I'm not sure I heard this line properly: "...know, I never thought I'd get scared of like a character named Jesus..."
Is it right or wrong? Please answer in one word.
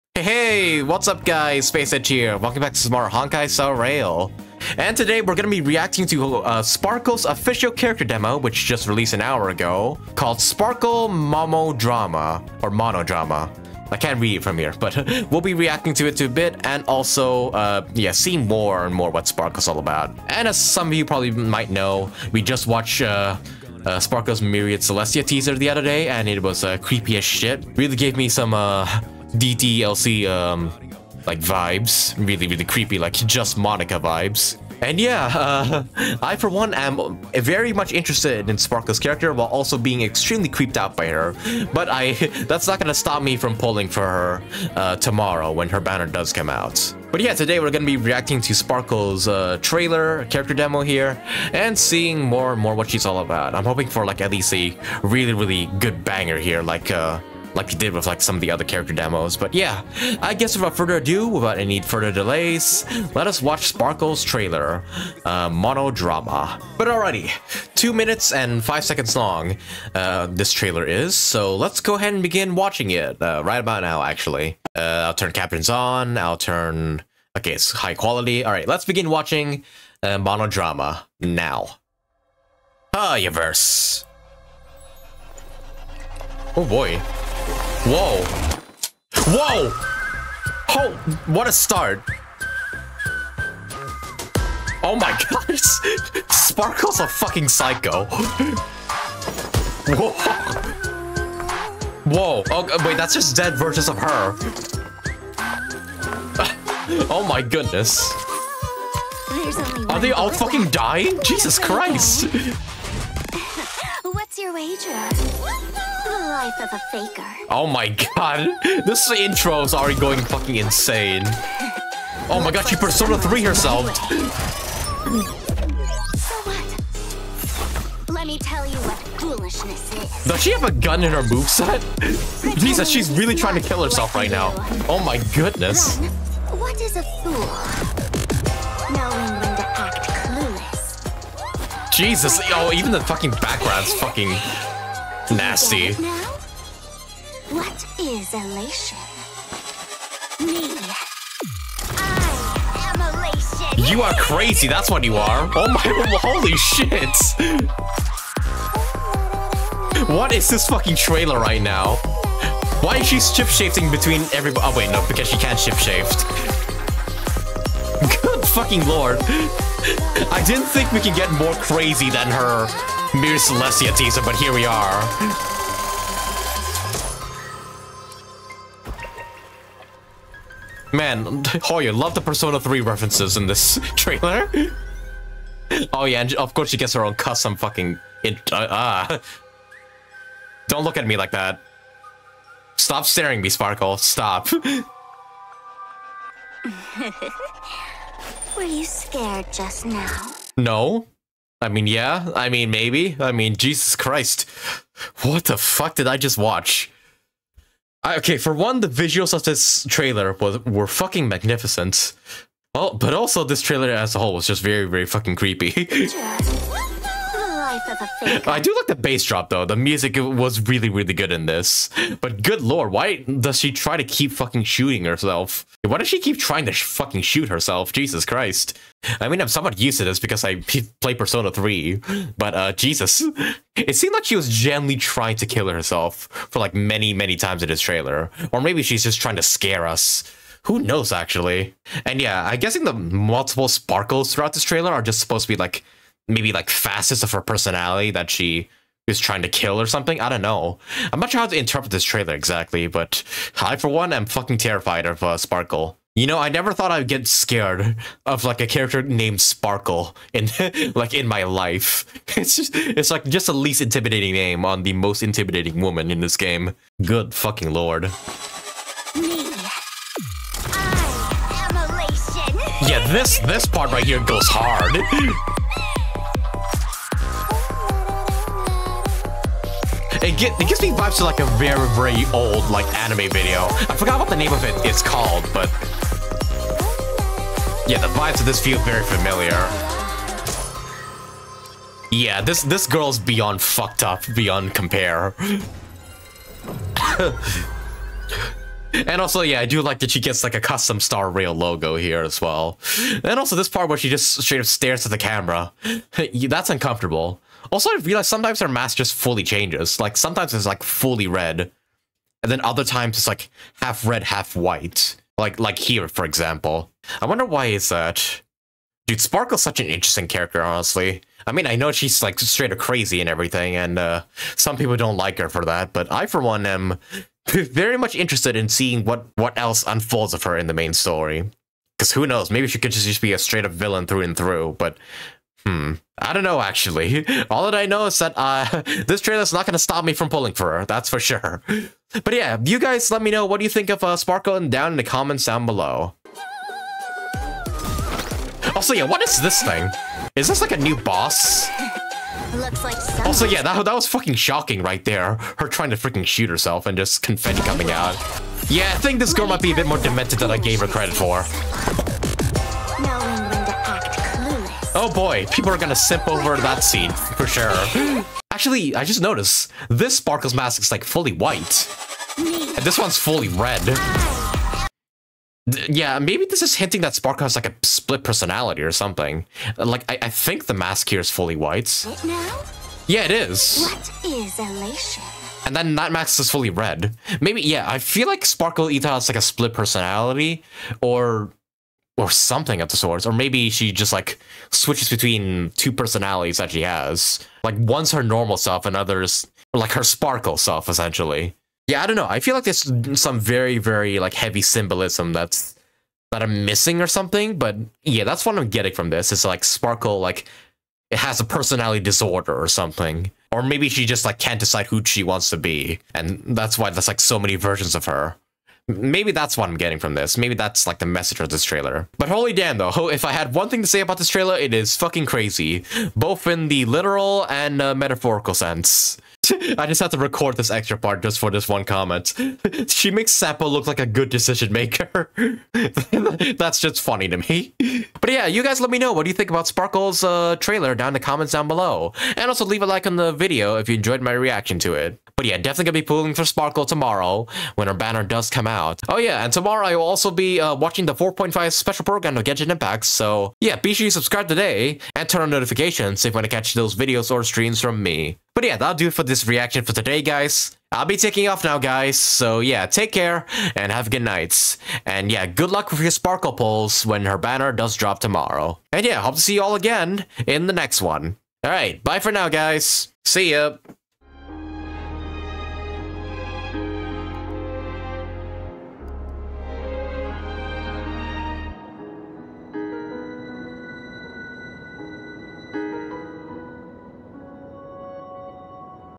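wrong.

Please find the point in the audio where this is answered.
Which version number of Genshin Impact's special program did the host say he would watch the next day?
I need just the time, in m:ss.
7:31.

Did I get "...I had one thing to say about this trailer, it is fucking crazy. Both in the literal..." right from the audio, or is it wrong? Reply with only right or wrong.
right.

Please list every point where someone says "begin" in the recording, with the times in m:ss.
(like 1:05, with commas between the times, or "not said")
1:12, 1:18.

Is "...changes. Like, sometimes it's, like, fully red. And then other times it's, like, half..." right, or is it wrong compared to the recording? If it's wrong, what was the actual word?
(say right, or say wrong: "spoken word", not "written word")
right.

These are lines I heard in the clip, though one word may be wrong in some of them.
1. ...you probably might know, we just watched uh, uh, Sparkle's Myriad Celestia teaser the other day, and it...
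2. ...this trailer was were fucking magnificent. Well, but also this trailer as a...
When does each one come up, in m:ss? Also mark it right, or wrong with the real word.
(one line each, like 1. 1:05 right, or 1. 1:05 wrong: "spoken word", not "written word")
1. 0:20 right
2. 3:29 right.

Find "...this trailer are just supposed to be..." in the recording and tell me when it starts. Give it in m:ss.
4:04.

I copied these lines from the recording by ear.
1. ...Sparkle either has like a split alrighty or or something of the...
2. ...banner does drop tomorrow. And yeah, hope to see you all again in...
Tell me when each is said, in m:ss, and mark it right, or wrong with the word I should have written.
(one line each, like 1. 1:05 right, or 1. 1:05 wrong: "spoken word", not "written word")
1. 6:28 wrong: "personality", not "alrighty"
2. 7:47 right.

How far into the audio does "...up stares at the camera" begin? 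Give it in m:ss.
5:04.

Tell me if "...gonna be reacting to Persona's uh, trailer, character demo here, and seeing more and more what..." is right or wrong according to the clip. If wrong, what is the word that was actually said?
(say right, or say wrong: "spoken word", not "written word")
wrong: "Sparkle", not "Persona".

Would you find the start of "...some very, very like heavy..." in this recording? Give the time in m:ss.
6:43.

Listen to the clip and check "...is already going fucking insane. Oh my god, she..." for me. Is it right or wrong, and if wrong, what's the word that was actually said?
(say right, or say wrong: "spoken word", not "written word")
right.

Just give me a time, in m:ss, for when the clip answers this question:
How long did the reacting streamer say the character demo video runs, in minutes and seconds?
1:07.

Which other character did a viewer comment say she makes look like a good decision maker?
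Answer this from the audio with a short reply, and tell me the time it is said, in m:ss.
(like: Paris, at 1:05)
Sampo, at 7:13.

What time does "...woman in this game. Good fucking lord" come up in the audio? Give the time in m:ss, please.
4:25.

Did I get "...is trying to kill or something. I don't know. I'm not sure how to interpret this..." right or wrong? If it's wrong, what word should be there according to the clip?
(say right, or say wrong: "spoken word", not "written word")
right.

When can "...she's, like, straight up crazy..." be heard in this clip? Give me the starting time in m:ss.
5:21.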